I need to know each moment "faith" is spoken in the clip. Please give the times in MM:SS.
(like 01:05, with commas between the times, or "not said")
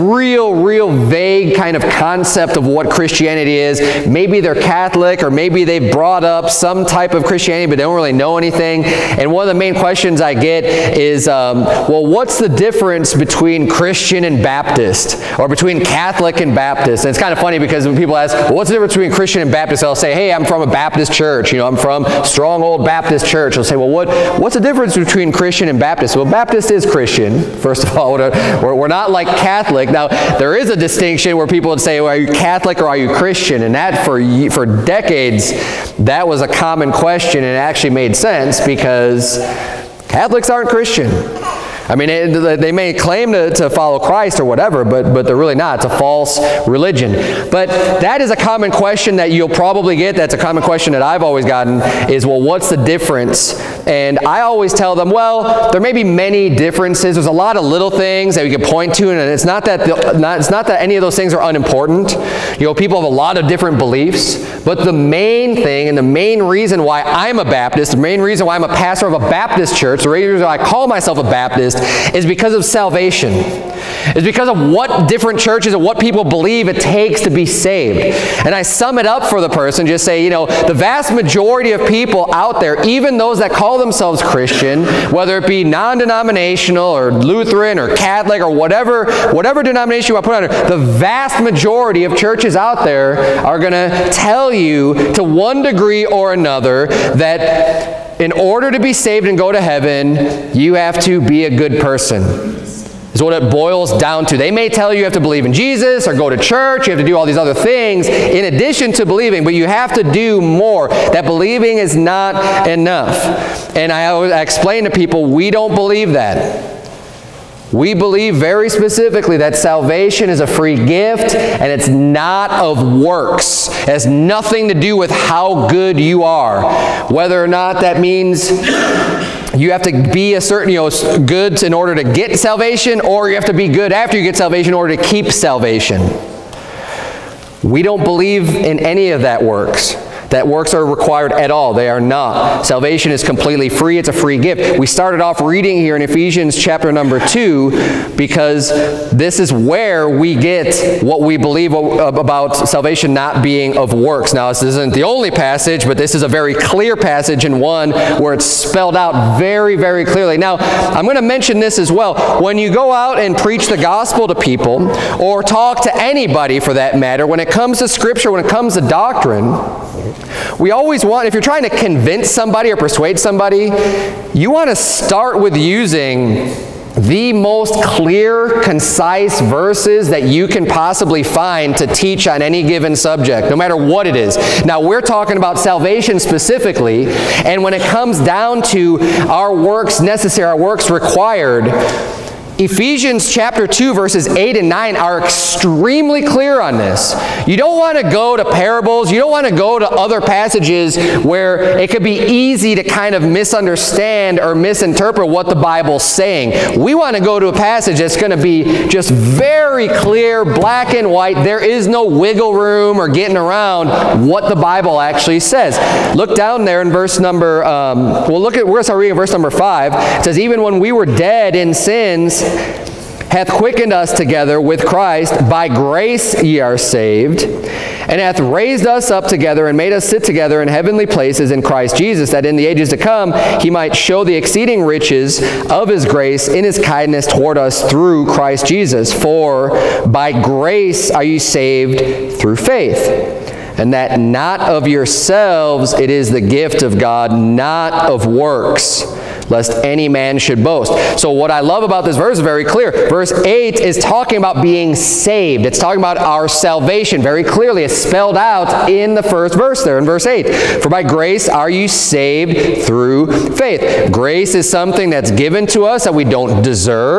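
04:02, 04:23.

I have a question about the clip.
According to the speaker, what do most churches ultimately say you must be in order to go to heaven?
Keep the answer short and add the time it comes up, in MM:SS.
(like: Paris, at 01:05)
a good person, at 01:41.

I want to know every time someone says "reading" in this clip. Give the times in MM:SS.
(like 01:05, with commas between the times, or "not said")
02:25, 03:38.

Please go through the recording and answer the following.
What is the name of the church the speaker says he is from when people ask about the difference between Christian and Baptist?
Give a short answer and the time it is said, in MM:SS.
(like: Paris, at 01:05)
Stronghold Baptist Church, at 00:22.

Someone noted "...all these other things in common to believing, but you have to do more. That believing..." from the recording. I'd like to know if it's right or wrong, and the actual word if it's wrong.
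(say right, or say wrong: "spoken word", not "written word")
wrong: "addition", not "common".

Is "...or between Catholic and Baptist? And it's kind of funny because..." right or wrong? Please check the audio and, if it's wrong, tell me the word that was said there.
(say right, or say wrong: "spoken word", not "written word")
right.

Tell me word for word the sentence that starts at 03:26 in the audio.
We want to go to a passage that's going to be just very clear, black and white.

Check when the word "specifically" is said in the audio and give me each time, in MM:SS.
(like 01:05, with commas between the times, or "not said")
01:58, 03:06.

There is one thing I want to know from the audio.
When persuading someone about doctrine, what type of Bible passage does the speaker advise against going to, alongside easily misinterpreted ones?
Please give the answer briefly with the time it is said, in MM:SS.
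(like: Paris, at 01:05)
parables, at 03:18.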